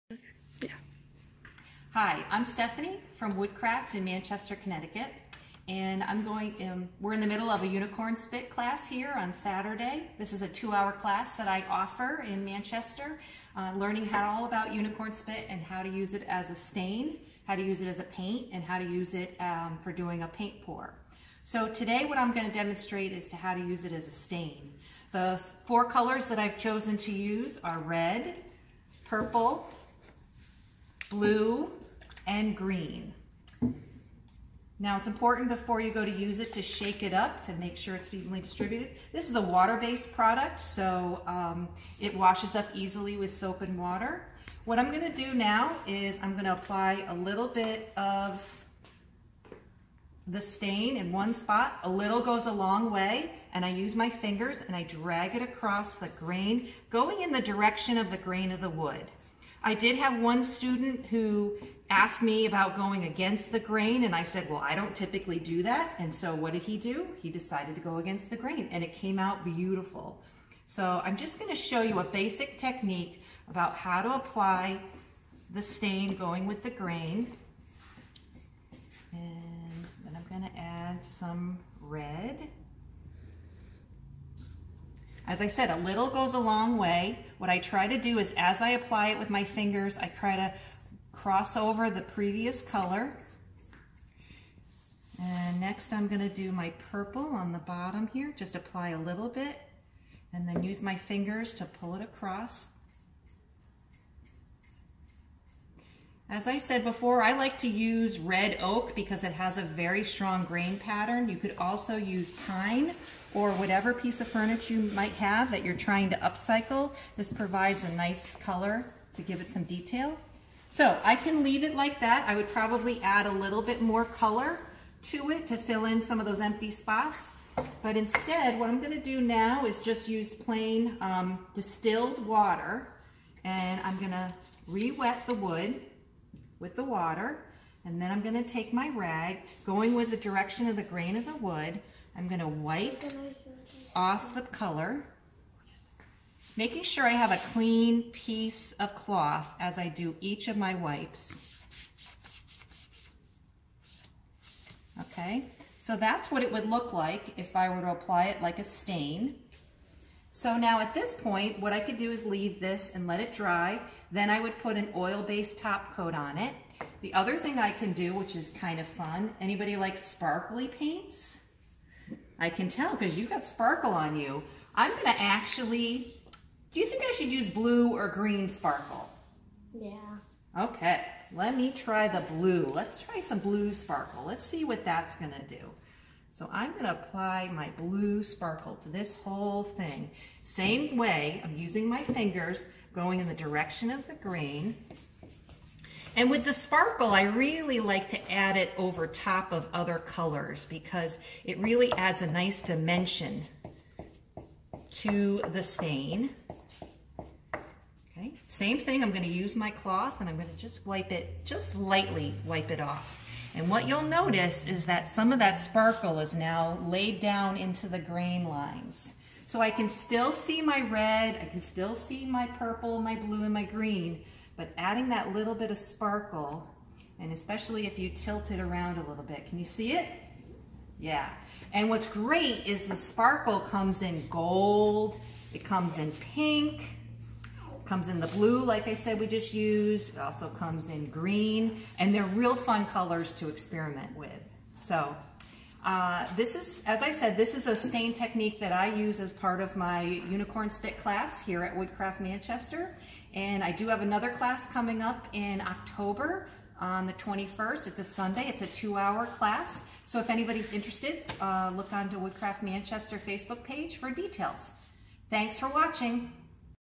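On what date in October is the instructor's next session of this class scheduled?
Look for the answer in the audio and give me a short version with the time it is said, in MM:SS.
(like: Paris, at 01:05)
October 21, at 04:17.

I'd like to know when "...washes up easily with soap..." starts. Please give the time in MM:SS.
00:42.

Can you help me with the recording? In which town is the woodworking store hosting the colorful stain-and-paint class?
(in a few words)
Manchester, Connecticut.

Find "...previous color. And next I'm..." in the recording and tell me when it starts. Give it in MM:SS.
01:32.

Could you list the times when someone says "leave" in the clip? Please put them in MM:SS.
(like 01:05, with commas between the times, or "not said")
02:01, 02:42.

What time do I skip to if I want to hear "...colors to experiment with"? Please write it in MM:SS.
04:02.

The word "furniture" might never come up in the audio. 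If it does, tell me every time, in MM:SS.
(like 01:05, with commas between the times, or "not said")
01:54.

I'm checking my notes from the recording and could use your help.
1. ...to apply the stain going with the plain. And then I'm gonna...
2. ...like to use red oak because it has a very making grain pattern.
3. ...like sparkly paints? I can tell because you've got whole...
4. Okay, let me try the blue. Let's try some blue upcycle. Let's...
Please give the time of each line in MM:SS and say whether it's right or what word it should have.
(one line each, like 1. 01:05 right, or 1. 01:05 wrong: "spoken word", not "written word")
1. 01:14 wrong: "grain", not "plain"
2. 01:47 wrong: "strong", not "making"
3. 02:49 wrong: "sparkle", not "whole"
4. 03:00 wrong: "sparkle", not "upcycle".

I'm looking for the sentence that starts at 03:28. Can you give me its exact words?
Okay, same thing, I'm gonna use my cloth and I'm gonna just wipe it, just lightly wipe it off.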